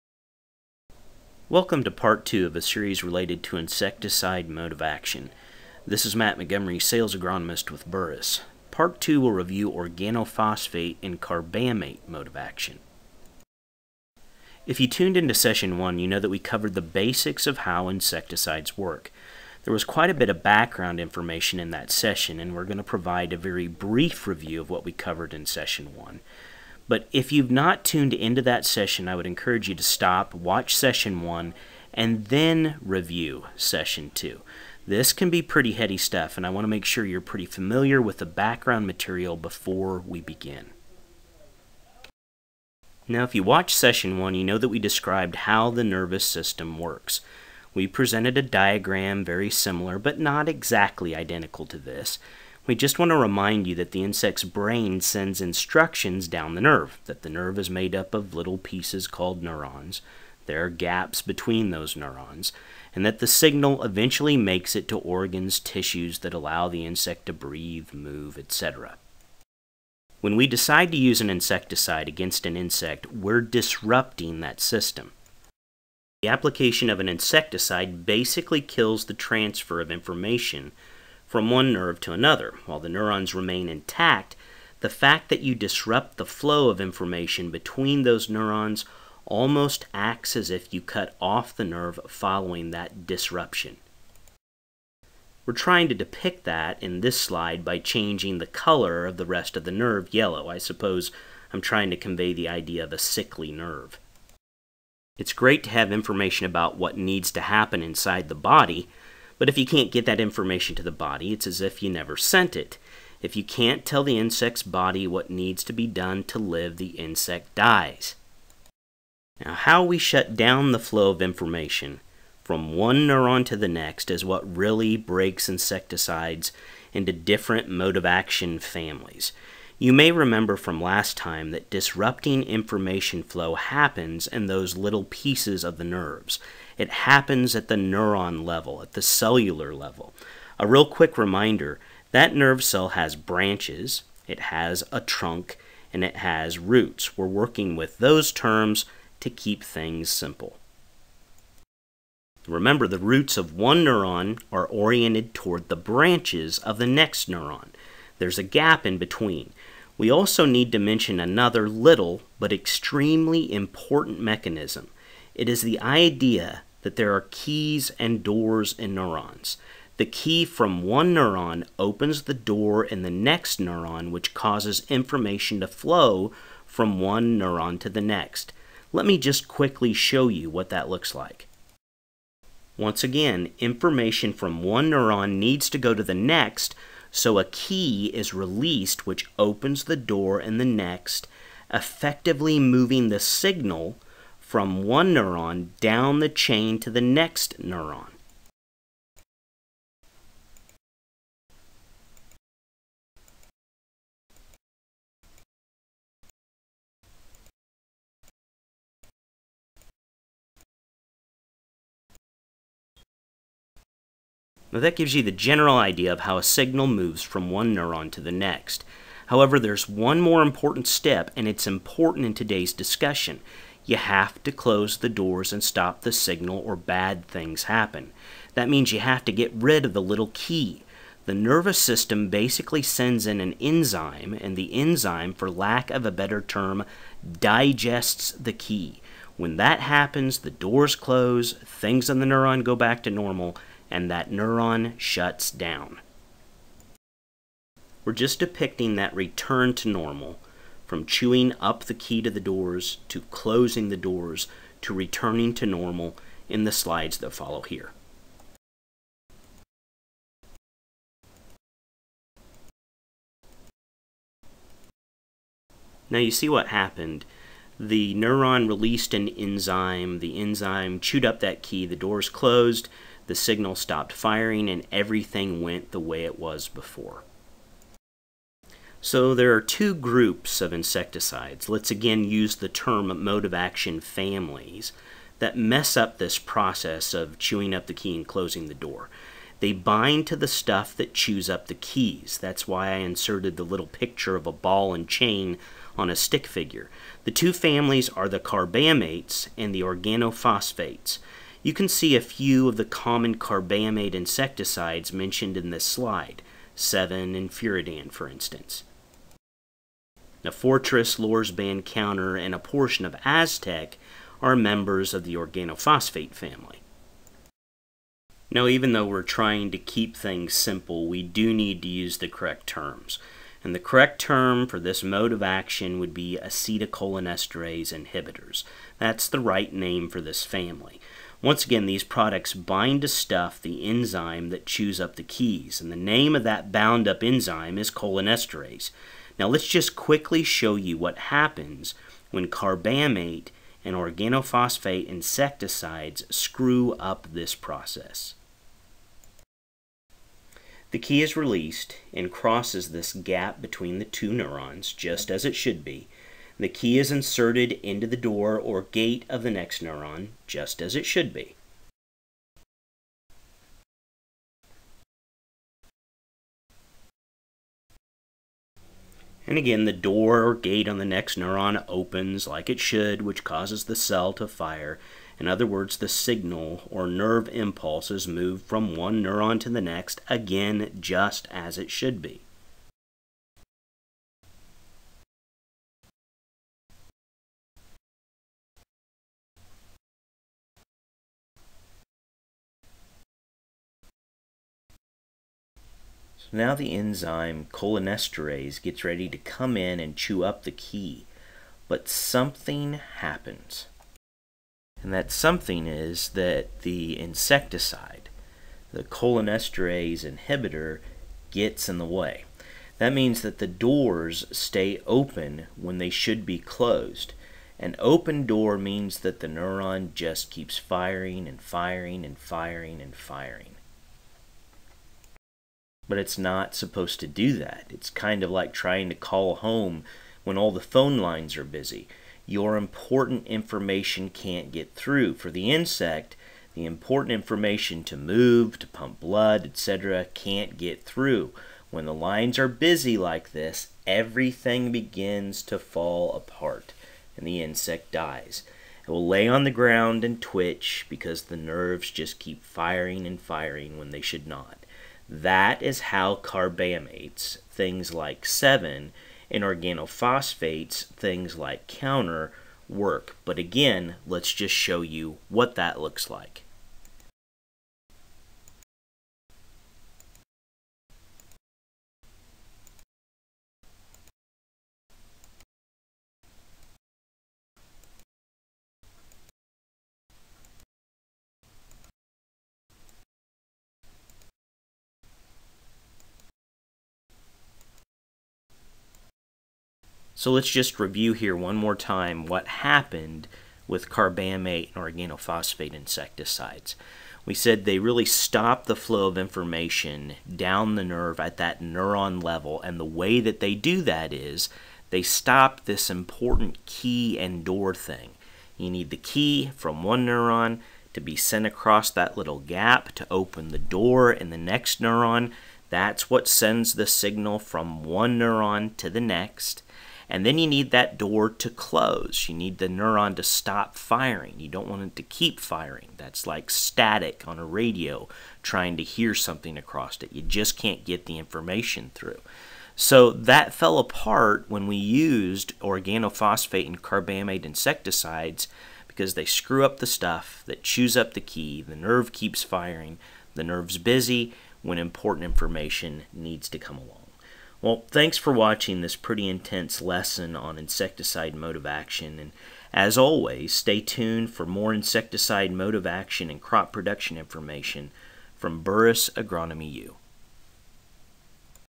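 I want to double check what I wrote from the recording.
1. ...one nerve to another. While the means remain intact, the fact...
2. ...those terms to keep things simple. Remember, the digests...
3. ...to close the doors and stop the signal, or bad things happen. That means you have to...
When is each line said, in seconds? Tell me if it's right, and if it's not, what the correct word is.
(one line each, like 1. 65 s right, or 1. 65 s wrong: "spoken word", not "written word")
1. 81 s wrong: "neurons", not "means"
2. 147 s wrong: "roots", not "digests"
3. 224 s right.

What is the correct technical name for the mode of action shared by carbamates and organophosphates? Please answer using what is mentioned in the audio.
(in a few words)
Acetylcholinesterase inhibitors.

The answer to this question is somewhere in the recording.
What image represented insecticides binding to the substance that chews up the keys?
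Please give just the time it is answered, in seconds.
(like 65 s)
294 s.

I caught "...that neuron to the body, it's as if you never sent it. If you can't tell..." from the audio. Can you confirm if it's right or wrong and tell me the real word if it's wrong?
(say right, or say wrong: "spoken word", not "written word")
wrong: "information", not "neuron".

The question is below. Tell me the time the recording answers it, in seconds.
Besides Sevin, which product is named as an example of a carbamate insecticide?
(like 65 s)
307 s.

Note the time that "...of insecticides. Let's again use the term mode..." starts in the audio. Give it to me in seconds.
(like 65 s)
280 s.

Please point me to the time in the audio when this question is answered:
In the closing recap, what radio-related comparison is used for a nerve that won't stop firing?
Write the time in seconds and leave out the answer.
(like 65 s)
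526 s.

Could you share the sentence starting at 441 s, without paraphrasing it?
When the lines are busy like this, everything begins to fall apart and the insect dies.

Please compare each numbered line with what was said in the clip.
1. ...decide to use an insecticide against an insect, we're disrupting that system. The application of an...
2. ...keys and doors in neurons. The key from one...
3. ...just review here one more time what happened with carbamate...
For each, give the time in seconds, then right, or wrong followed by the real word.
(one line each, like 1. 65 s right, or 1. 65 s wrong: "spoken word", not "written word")
1. 70 s right
2. 167 s right
3. 490 s right.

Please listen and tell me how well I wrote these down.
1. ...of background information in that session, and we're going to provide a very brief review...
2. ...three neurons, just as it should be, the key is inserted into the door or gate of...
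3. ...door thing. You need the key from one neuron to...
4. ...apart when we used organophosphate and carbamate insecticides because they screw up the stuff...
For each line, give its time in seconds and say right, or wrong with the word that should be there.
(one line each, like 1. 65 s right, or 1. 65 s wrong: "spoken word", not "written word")
1. 20 s right
2. 354 s wrong: "two", not "three"
3. 507 s right
4. 533 s right.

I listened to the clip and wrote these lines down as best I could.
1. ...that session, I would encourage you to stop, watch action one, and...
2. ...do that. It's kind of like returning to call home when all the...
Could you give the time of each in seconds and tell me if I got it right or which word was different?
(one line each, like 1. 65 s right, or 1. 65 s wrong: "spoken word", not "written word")
1. 28 s wrong: "session", not "action"
2. 427 s wrong: "trying", not "returning".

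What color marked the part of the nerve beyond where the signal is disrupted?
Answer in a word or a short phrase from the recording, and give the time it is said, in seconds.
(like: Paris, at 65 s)
Yellow, at 100 s.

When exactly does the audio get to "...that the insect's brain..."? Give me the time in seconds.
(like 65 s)
53 s.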